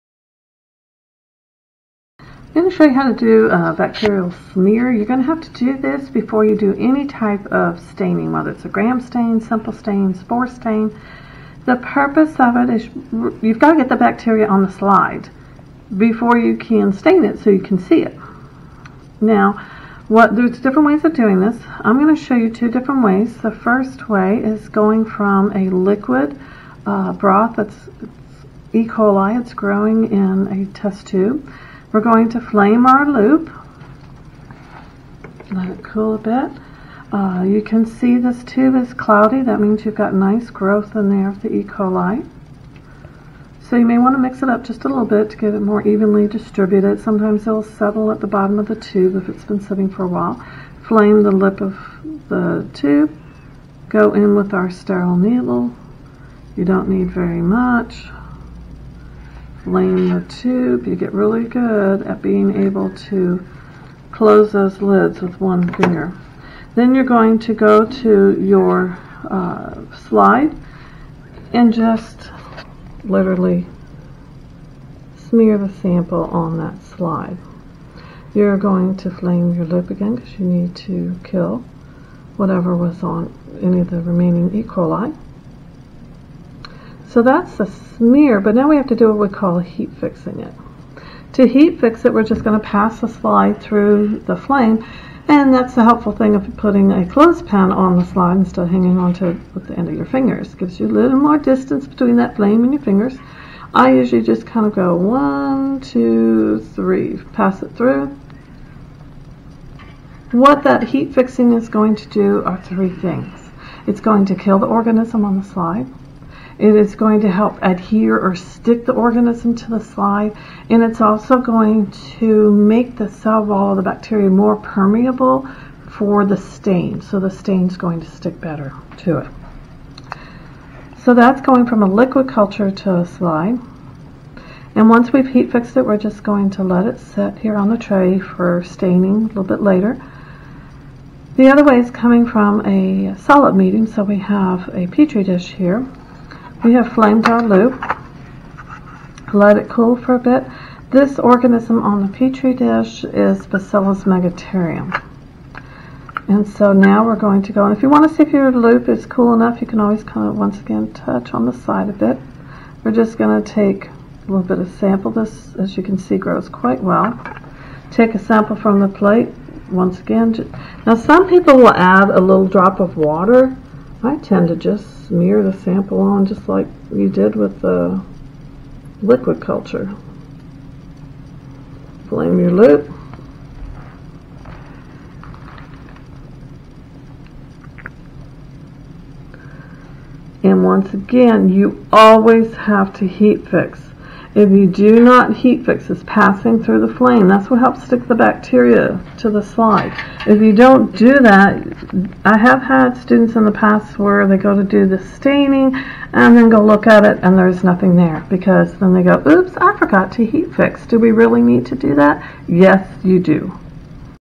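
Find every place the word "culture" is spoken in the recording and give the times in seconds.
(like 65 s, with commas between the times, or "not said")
132 s, 179 s.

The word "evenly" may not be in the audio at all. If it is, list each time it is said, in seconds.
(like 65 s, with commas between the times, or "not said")
45 s.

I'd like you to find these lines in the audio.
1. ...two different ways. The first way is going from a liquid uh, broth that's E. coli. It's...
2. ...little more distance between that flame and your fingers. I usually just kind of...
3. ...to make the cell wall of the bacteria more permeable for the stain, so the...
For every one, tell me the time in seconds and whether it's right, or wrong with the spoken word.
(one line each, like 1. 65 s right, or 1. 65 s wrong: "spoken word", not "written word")
1. 22 s right
2. 100 s right
3. 122 s right.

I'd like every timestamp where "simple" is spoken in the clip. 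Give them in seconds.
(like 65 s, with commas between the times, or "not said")
9 s.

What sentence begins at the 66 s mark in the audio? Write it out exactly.
Then you're going to go to your uh, slide and just literally smear the sample on that slide.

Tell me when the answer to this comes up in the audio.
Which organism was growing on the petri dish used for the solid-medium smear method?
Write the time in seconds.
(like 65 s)
153 s.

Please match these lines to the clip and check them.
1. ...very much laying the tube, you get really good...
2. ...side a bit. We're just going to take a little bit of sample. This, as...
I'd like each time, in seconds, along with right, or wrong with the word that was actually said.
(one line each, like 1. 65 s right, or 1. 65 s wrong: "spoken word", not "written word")
1. 57 s right
2. 161 s right.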